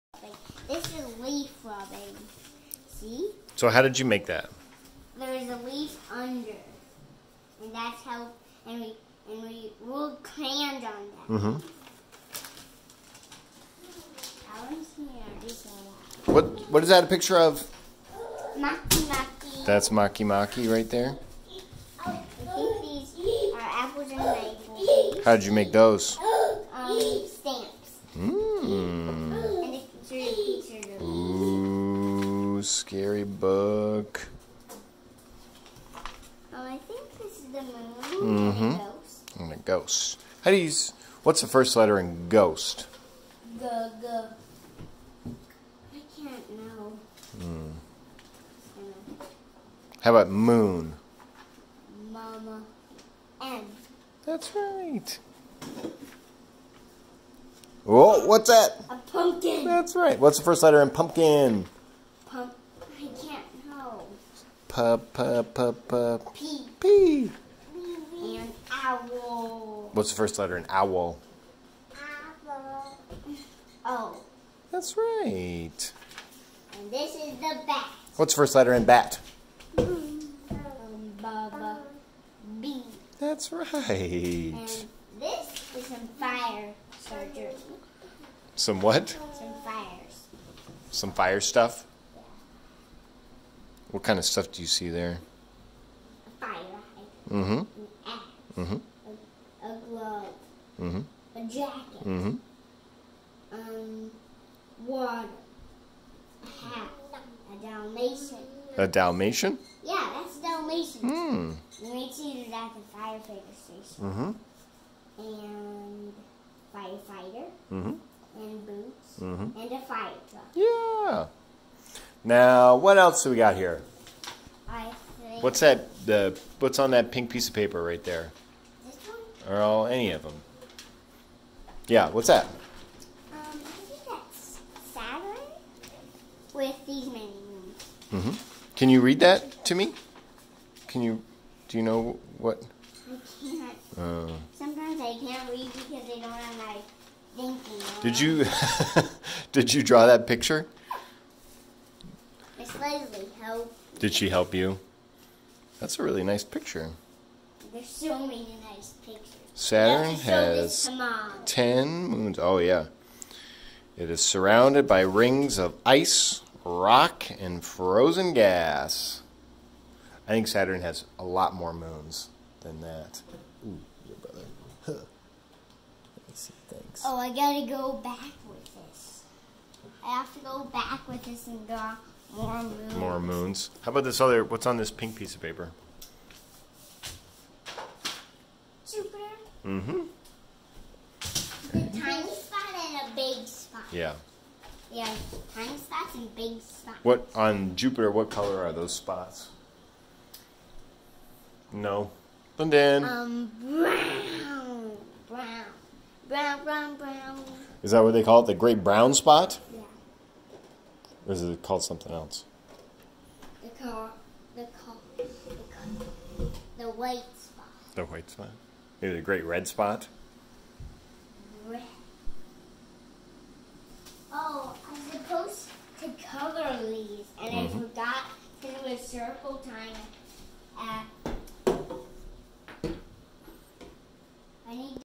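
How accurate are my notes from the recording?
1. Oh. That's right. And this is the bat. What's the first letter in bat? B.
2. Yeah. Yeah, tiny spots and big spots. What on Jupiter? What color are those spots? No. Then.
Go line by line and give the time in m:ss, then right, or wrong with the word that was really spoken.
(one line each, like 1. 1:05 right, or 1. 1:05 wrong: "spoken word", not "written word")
1. 1:13 right
2. 3:13 right.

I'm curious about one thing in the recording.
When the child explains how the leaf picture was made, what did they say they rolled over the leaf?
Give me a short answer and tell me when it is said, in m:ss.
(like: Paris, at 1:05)
crayons, at 0:10.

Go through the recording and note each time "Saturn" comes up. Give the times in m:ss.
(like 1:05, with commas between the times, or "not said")
2:14, 2:39, 2:50.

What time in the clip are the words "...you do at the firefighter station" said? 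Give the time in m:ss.
1:52.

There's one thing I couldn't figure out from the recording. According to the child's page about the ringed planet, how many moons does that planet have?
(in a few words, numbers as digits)
10.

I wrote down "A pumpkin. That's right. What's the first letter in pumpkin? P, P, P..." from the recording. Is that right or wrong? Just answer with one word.
right.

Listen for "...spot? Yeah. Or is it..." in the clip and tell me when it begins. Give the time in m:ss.
3:29.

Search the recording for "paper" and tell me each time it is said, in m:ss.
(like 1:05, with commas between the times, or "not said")
2:07, 3:05.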